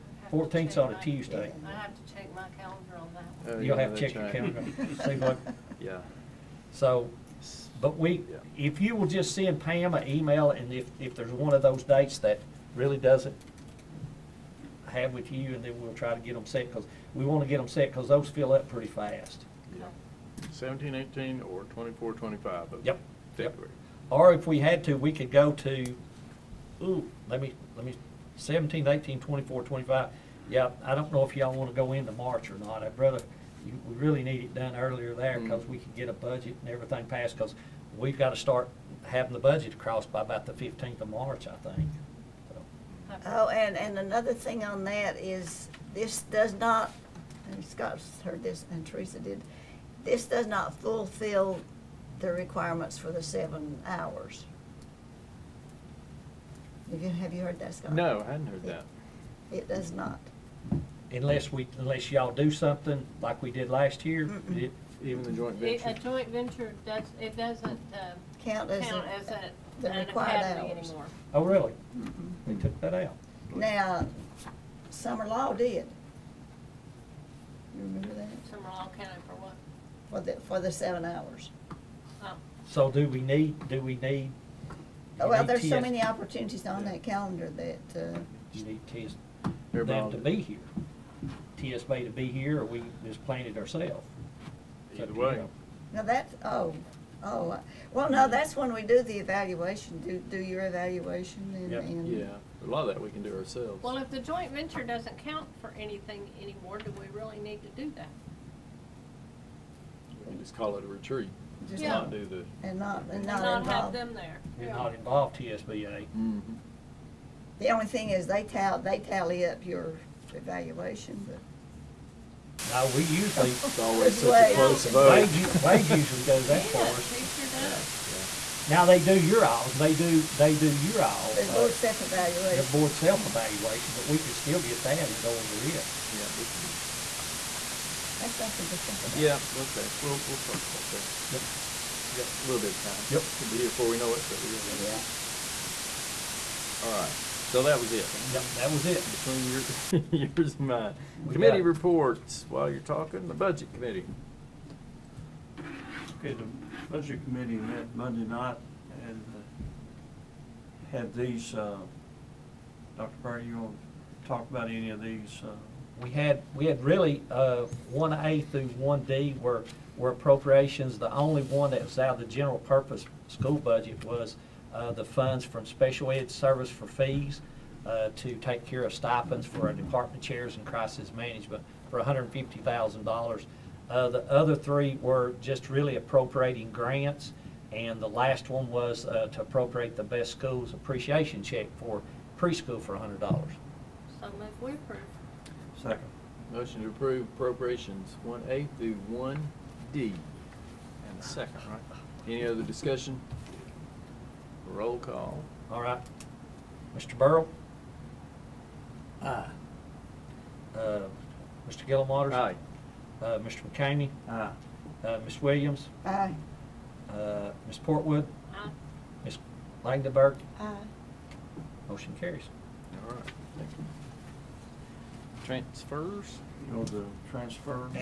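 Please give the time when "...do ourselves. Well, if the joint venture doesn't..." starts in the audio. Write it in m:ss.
1:43.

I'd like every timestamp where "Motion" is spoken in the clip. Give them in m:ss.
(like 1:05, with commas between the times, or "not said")
3:16, 3:41.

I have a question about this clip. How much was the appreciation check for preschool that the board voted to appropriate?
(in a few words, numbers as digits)
$100.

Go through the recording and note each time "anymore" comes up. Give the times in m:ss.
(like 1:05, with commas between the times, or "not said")
1:10, 1:46.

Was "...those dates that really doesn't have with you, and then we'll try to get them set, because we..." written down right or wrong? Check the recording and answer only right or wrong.
right.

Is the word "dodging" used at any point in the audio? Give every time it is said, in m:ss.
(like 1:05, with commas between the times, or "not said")
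not said.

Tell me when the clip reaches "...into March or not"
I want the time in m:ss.
0:31.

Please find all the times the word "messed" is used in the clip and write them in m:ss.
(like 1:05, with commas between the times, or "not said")
not said.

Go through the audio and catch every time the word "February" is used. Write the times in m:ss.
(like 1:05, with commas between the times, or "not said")
0:23.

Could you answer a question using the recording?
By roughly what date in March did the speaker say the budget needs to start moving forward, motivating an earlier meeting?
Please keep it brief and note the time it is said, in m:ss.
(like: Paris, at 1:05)
15th of March, at 0:40.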